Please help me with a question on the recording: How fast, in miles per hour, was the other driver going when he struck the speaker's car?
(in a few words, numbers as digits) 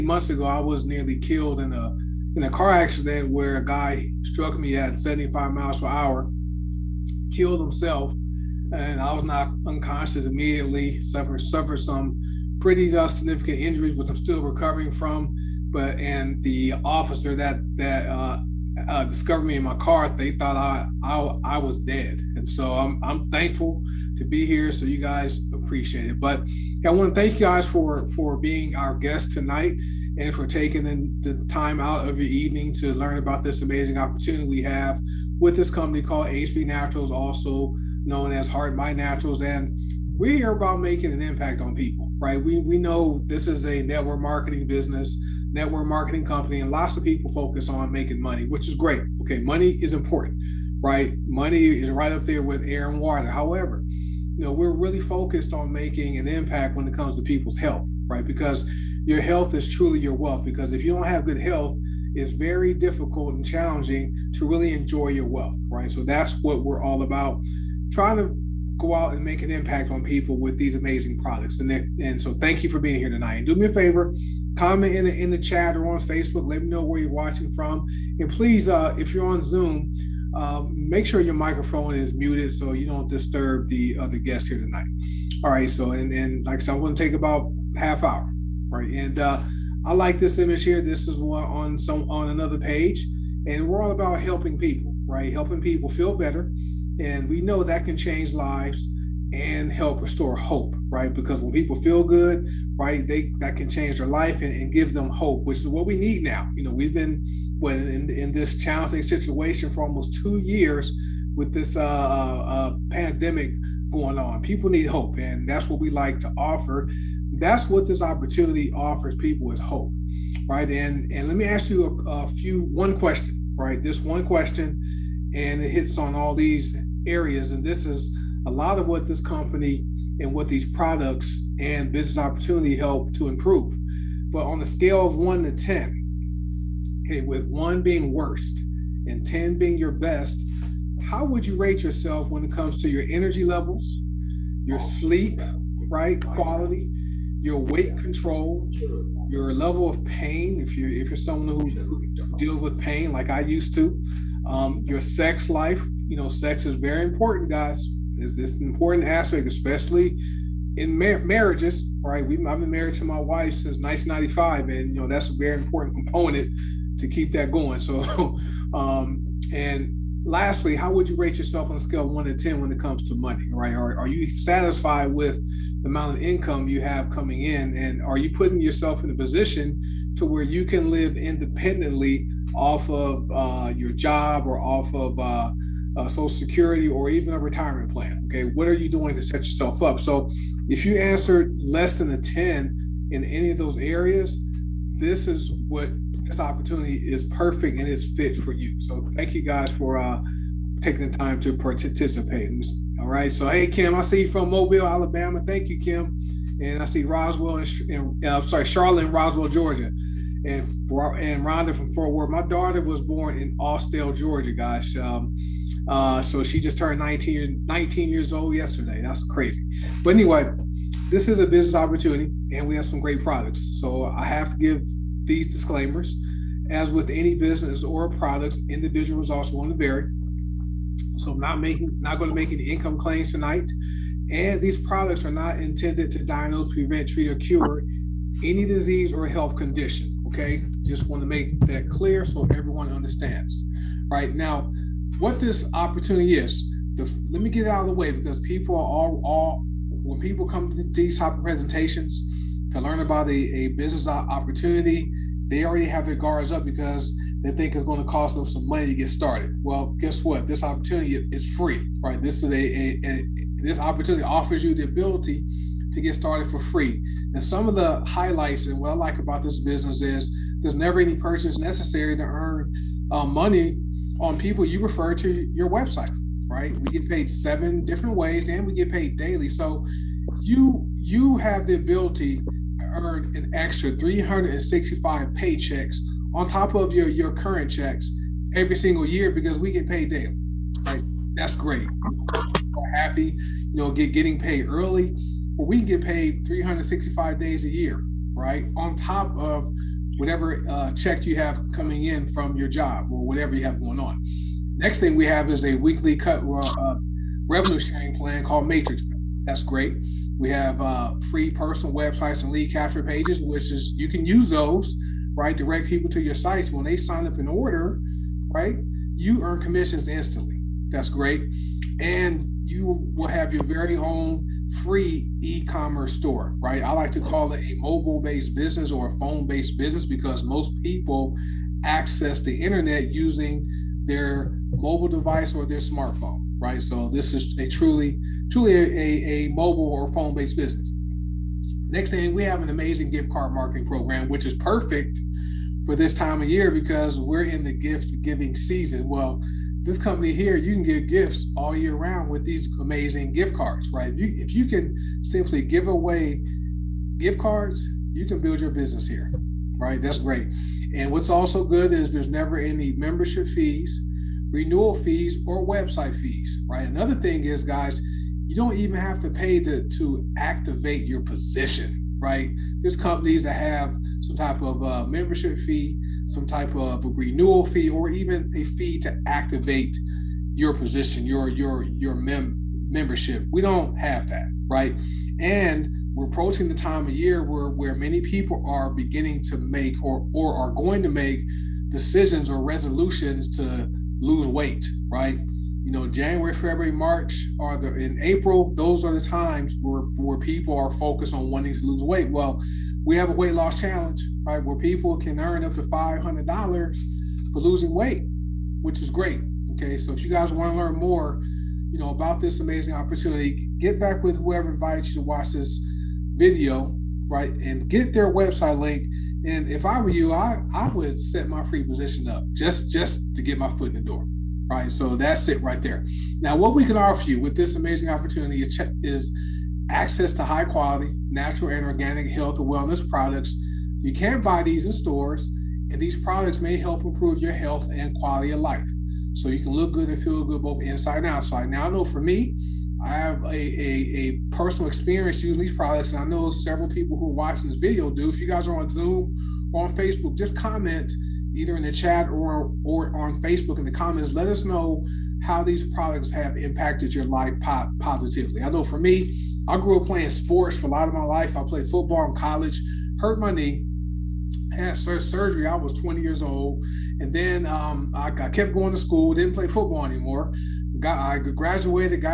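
75.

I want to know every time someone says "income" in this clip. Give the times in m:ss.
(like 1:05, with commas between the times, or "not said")
2:56, 3:52.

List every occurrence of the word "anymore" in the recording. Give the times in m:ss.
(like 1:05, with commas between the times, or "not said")
7:50.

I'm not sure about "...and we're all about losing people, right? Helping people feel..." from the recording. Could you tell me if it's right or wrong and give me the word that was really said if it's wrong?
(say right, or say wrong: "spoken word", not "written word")
wrong: "helping", not "losing".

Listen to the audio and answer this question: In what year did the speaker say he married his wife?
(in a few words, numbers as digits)
1995.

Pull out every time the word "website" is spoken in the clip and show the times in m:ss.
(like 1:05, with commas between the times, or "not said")
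4:35, 5:11, 6:05, 6:58.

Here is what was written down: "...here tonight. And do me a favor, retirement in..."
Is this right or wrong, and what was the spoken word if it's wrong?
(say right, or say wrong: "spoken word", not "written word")
wrong: "comment", not "retirement".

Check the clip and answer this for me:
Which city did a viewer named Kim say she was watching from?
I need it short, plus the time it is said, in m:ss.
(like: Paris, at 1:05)
Mobile, Alabama, at 3:24.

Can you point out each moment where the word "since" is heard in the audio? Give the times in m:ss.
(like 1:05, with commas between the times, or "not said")
2:43.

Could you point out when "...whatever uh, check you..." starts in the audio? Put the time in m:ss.
5:00.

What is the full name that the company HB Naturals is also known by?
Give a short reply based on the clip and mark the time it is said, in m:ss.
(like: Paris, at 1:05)
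Heart Body Naturals, at 0:38.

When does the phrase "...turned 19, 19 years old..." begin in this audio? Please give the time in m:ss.
3:36.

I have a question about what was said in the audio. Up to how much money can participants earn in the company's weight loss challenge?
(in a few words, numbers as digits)
$500.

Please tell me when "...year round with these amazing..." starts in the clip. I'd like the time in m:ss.
5:51.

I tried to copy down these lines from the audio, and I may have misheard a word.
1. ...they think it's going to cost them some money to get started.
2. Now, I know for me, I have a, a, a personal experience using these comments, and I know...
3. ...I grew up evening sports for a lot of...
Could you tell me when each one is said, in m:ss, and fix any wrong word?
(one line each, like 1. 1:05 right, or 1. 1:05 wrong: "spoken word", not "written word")
1. 4:17 right
2. 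7:21 wrong: "products", not "comments"
3. 7:39 wrong: "playing", not "evening".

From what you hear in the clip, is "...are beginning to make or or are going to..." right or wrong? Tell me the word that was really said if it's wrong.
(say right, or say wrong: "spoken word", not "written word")
right.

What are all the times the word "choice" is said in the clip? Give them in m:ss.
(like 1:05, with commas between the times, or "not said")
not said.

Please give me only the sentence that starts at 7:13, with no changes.
You can buy these in stores, and these products may help improve your health and quality of life.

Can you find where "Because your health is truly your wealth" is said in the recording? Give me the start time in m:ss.
0:58.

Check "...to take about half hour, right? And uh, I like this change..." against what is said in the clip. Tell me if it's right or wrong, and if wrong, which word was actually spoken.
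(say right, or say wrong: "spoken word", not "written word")
wrong: "image", not "change".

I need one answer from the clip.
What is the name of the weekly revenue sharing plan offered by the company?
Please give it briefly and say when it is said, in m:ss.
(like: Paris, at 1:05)
Matrix, at 5:08.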